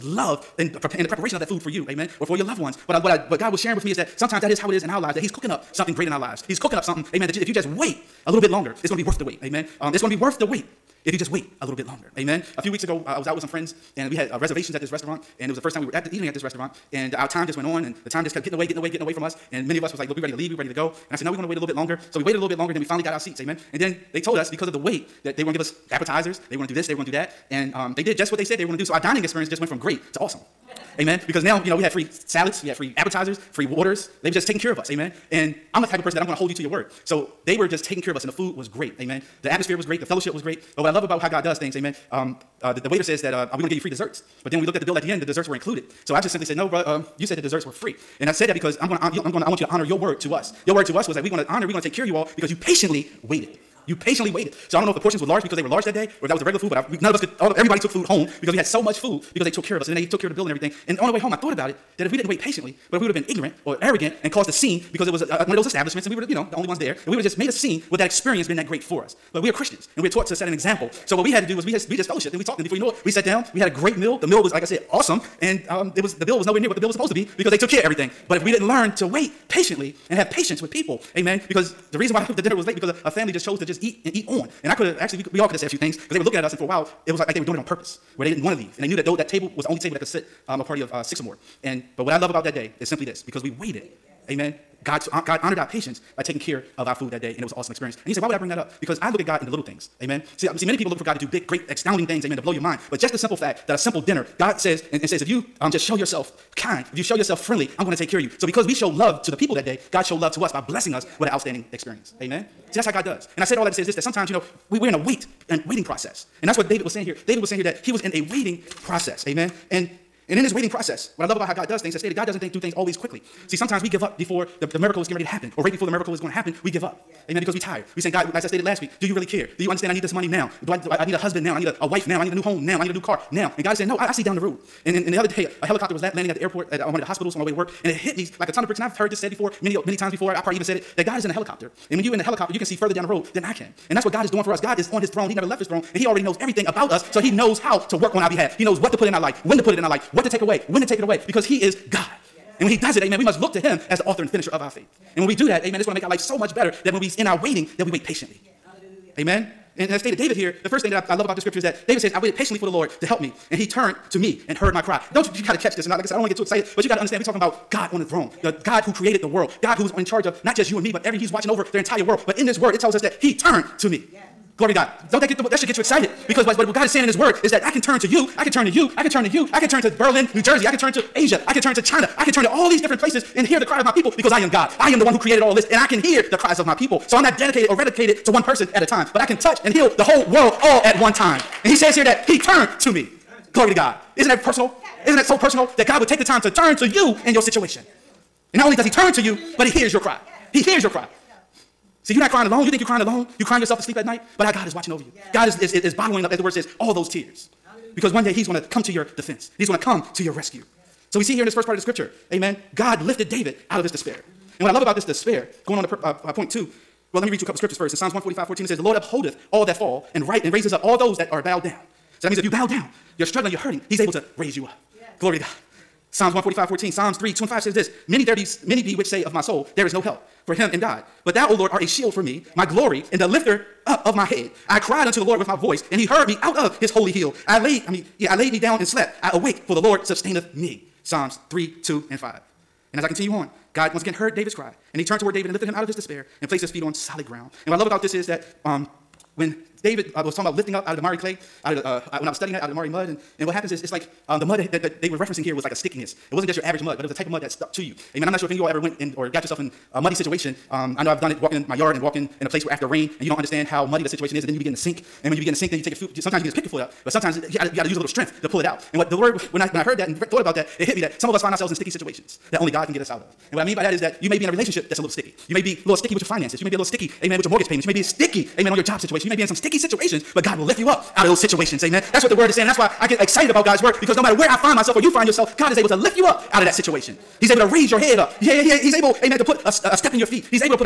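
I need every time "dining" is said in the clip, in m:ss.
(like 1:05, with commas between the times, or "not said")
0:28.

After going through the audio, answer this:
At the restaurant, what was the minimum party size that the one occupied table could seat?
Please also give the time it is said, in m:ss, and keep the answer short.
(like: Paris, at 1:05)
6, at 1:31.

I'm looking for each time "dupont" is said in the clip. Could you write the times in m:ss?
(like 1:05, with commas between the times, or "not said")
not said.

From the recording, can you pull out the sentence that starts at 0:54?
So I don't know if the portions were large because they were large that day, or if that was the regular food.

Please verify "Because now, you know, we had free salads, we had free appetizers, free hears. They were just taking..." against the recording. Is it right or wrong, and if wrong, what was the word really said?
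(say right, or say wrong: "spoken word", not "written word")
wrong: "waters", not "hears".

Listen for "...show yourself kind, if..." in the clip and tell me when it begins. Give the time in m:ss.
1:45.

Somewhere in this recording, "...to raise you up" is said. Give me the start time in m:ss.
3:44.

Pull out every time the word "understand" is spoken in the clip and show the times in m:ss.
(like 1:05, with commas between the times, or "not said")
2:09, 2:47, 4:23.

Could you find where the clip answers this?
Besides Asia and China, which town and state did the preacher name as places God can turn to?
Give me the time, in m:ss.
2:59.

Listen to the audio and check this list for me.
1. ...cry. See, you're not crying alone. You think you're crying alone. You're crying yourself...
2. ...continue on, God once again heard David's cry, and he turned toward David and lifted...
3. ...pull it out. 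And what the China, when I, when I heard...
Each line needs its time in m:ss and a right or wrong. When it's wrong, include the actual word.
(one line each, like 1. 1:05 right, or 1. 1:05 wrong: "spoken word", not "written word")
1. 3:20 right
2. 4:03 right
3. 4:28 wrong: "Lord", not "China".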